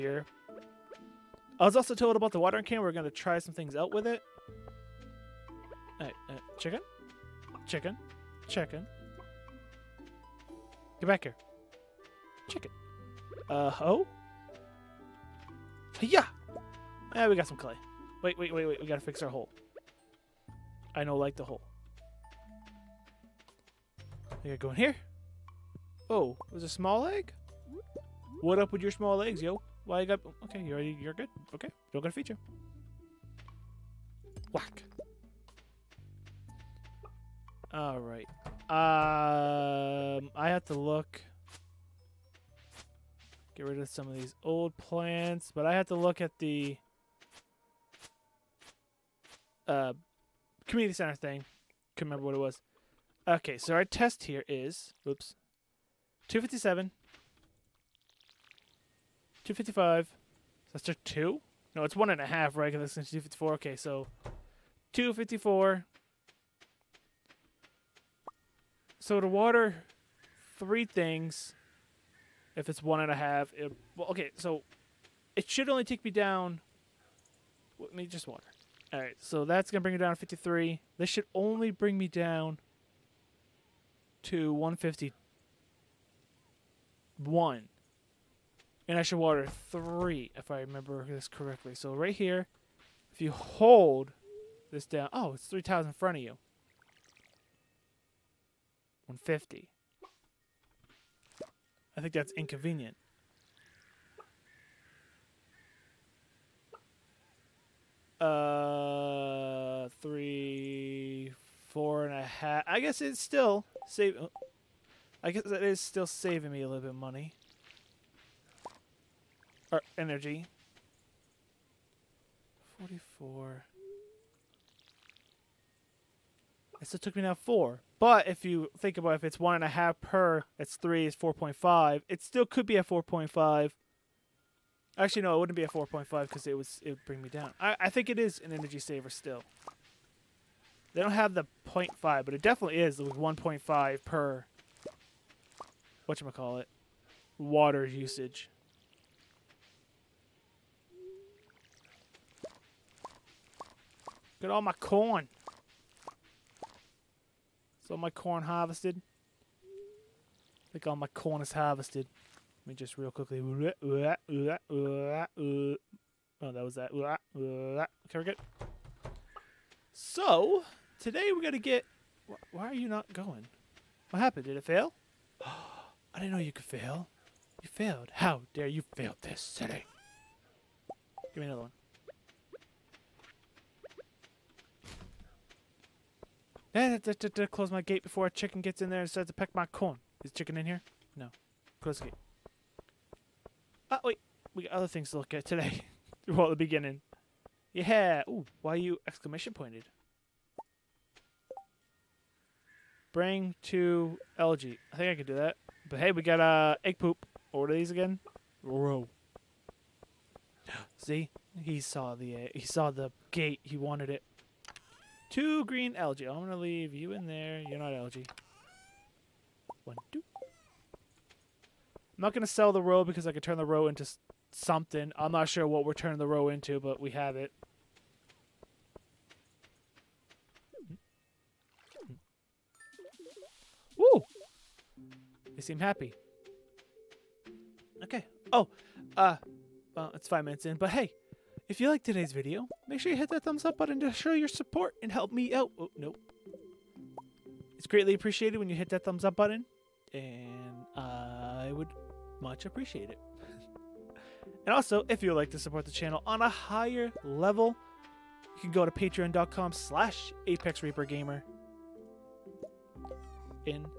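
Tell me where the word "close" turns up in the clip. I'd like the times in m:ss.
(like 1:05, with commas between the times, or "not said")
3:07, 3:11.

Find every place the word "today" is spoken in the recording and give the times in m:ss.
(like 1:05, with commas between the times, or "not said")
2:50, 3:15, 4:02.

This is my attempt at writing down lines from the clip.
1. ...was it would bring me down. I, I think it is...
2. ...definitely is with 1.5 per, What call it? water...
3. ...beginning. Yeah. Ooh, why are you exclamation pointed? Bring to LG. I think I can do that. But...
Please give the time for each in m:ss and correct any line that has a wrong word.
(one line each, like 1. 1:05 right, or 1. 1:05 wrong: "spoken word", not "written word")
1. 2:16 right
2. 2:22 right
3. 3:16 right.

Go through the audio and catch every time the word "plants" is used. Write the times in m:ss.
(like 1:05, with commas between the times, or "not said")
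0:44.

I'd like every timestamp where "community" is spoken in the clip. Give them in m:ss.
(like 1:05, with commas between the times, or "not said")
0:50.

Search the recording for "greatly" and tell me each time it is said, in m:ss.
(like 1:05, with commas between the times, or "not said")
4:07.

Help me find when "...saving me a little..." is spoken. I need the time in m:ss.
1:56.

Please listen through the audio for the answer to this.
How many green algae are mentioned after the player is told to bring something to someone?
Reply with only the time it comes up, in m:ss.
3:35.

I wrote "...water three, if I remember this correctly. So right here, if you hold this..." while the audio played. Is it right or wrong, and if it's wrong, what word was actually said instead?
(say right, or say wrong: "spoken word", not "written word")
right.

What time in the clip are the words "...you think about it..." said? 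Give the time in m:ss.
2:08.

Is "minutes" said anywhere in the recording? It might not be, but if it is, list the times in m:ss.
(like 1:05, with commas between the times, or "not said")
4:00.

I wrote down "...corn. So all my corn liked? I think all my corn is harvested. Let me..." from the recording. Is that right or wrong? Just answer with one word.
wrong.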